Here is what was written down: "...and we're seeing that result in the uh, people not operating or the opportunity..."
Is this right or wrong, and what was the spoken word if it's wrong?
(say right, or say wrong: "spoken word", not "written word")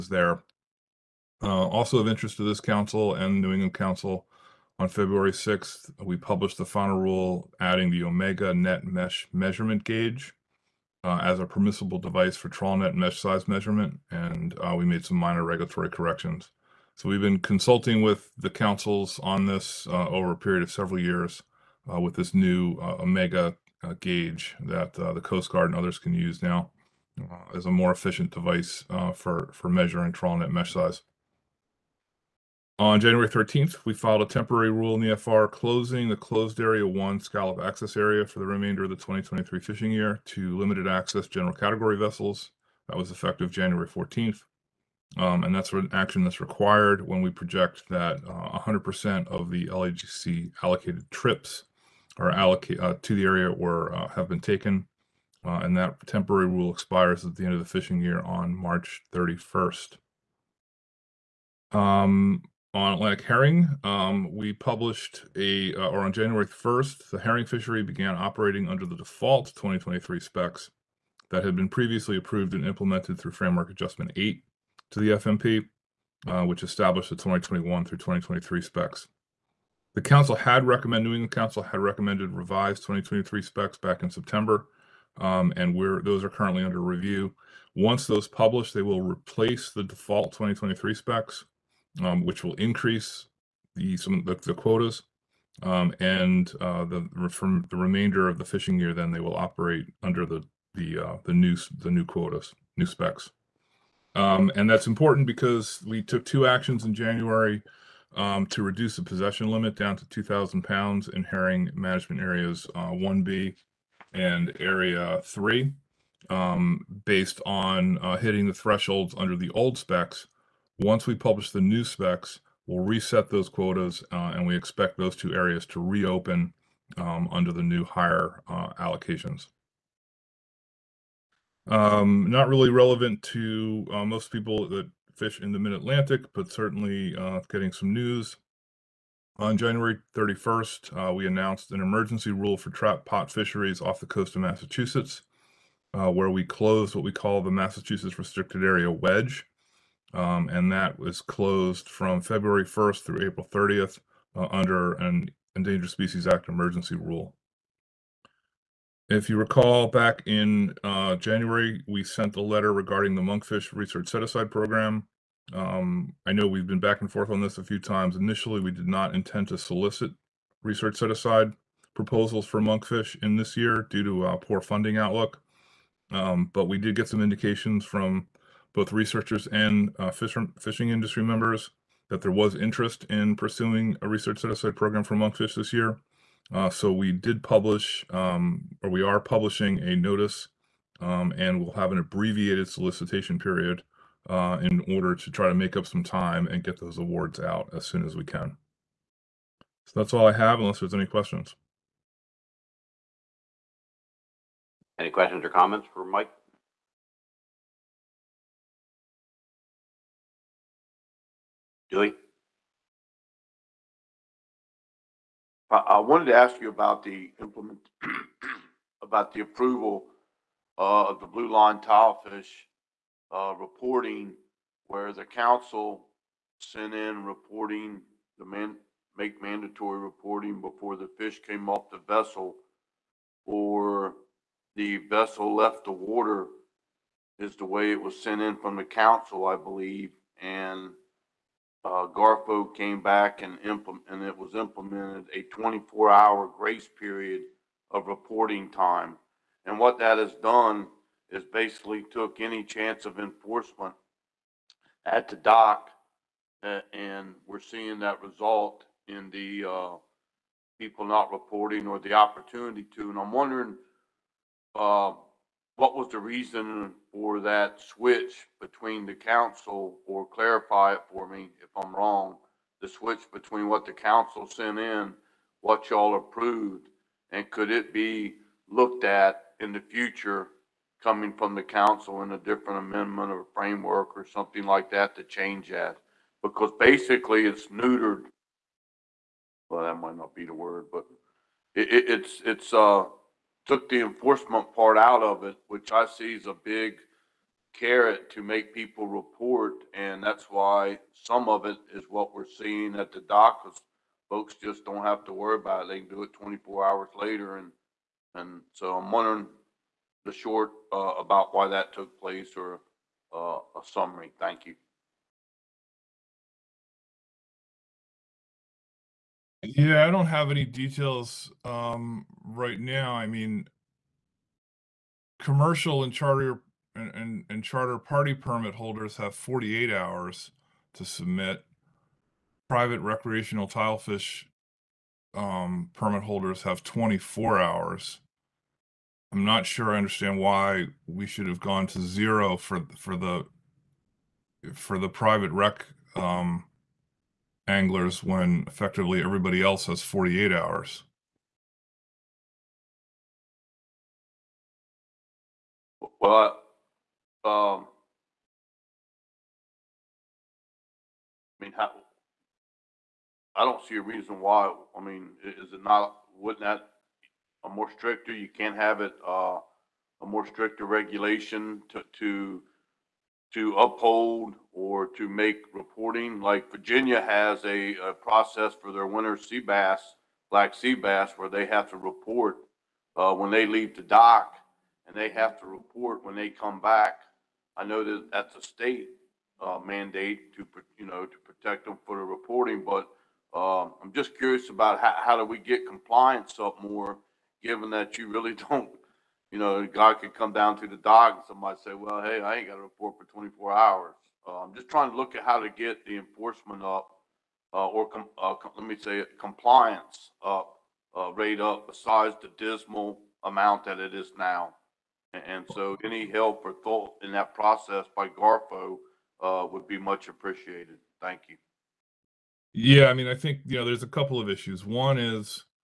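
wrong: "reporting", not "operating".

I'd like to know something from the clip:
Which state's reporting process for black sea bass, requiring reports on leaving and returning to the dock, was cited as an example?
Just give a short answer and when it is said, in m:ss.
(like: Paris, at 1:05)
Virginia, at 6:16.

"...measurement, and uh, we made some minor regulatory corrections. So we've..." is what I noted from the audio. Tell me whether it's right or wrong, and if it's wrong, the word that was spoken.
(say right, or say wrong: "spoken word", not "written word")
right.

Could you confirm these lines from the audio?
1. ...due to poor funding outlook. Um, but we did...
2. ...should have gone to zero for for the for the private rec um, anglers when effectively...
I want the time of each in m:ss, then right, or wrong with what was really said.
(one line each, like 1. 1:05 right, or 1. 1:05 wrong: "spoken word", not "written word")
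1. 2:53 right
2. 5:41 right.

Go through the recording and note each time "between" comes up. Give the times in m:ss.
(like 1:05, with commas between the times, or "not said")
4:28, 4:33.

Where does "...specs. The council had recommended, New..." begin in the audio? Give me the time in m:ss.
1:18.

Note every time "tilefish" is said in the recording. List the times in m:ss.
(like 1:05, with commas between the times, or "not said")
3:41, 5:33.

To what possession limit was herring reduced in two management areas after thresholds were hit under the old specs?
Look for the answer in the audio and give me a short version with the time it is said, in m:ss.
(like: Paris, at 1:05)
2,000 pounds, at 1:50.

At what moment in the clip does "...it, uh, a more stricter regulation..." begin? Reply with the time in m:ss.
6:09.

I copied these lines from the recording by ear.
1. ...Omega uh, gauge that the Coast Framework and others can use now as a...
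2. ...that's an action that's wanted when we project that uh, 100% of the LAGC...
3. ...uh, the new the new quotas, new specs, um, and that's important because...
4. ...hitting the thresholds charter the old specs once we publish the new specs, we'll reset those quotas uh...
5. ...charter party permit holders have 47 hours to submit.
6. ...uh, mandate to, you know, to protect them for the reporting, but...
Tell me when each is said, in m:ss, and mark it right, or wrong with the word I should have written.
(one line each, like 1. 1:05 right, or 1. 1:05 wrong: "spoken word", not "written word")
1. 0:22 wrong: "Guard", not "Framework"
2. 0:45 wrong: "required", not "wanted"
3. 1:40 right
4. 1:58 wrong: "under", not "charter"
5. 5:27 wrong: "48", not "47"
6. 6:29 right.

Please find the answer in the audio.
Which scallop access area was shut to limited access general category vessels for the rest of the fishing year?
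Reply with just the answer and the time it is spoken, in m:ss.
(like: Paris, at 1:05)
Closed Area 1, at 0:36.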